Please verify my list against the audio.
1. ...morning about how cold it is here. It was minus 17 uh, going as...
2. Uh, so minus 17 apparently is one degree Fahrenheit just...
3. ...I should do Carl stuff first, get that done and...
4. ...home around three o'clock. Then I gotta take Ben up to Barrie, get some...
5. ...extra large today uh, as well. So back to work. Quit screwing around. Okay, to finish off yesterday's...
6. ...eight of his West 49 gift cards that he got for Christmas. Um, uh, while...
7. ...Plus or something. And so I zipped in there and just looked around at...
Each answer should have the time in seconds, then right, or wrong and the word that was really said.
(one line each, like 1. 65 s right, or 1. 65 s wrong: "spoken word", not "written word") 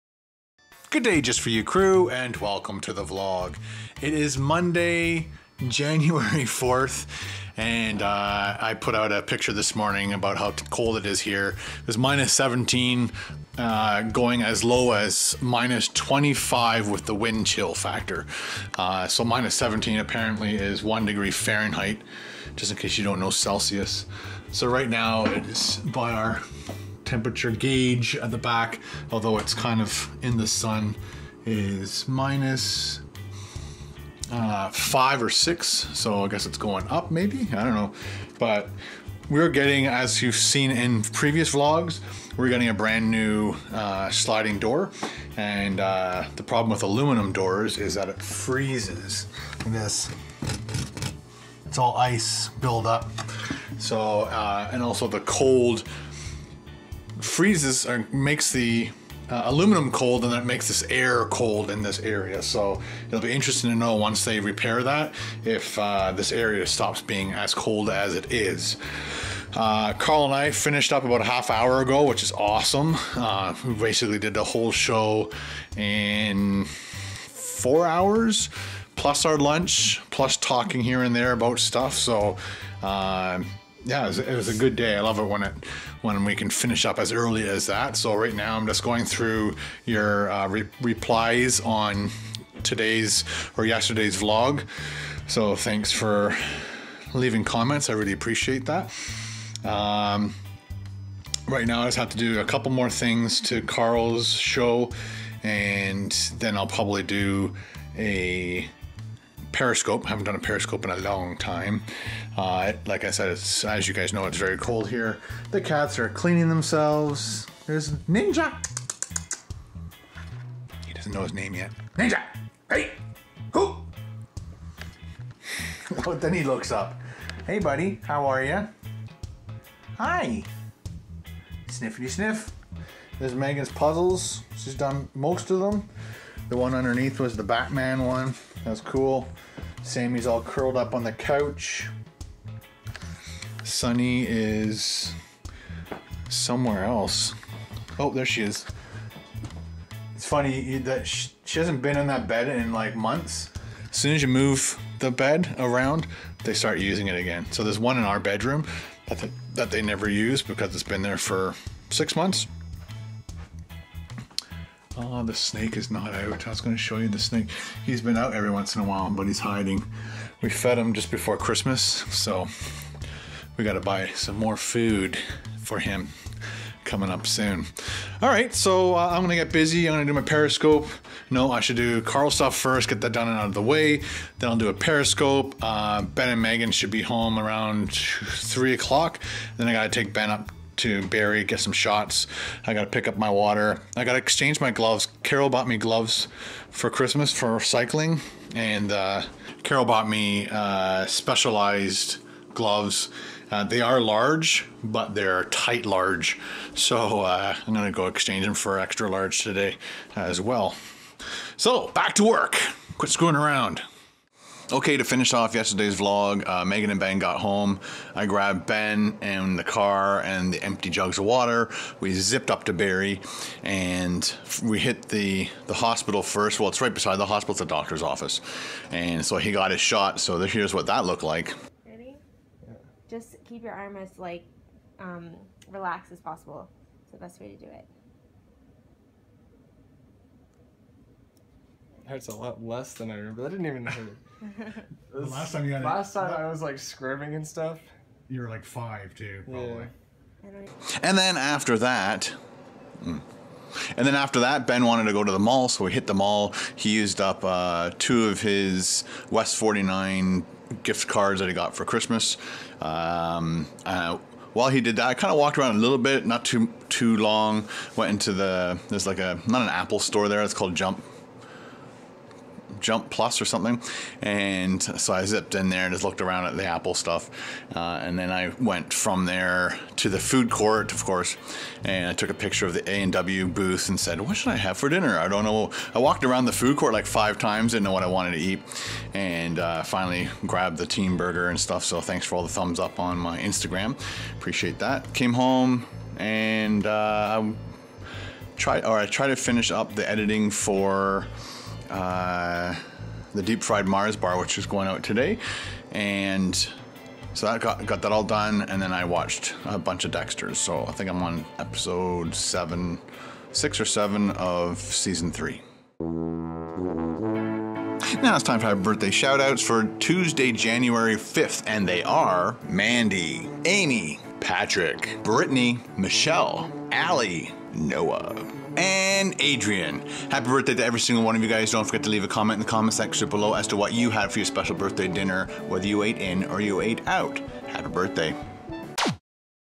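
1. 9 s right
2. 18 s right
3. 181 s right
4. 187 s right
5. 208 s right
6. 257 s wrong: "two", not "eight"
7. 273 s right.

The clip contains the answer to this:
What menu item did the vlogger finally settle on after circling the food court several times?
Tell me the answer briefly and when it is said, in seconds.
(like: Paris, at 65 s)
Teen Burger, at 290 s.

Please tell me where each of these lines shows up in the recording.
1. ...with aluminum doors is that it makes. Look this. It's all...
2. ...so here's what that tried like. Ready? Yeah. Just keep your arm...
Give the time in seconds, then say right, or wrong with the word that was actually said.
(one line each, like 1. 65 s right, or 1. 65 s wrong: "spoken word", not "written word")
1. 46 s wrong: "freezes", not "makes"
2. 230 s wrong: "looked", not "tried".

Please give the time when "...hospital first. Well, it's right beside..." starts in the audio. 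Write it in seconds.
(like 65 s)
225 s.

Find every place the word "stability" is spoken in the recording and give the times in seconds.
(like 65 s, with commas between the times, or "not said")
not said.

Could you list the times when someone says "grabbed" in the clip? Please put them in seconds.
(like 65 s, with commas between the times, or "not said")
218 s, 290 s.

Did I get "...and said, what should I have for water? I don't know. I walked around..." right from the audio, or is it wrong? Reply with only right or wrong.
wrong.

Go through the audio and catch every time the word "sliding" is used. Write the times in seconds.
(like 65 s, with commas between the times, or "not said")
44 s.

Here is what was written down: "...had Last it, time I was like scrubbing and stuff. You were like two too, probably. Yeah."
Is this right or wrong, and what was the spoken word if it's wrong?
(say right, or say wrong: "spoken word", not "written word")
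wrong: "five", not "two".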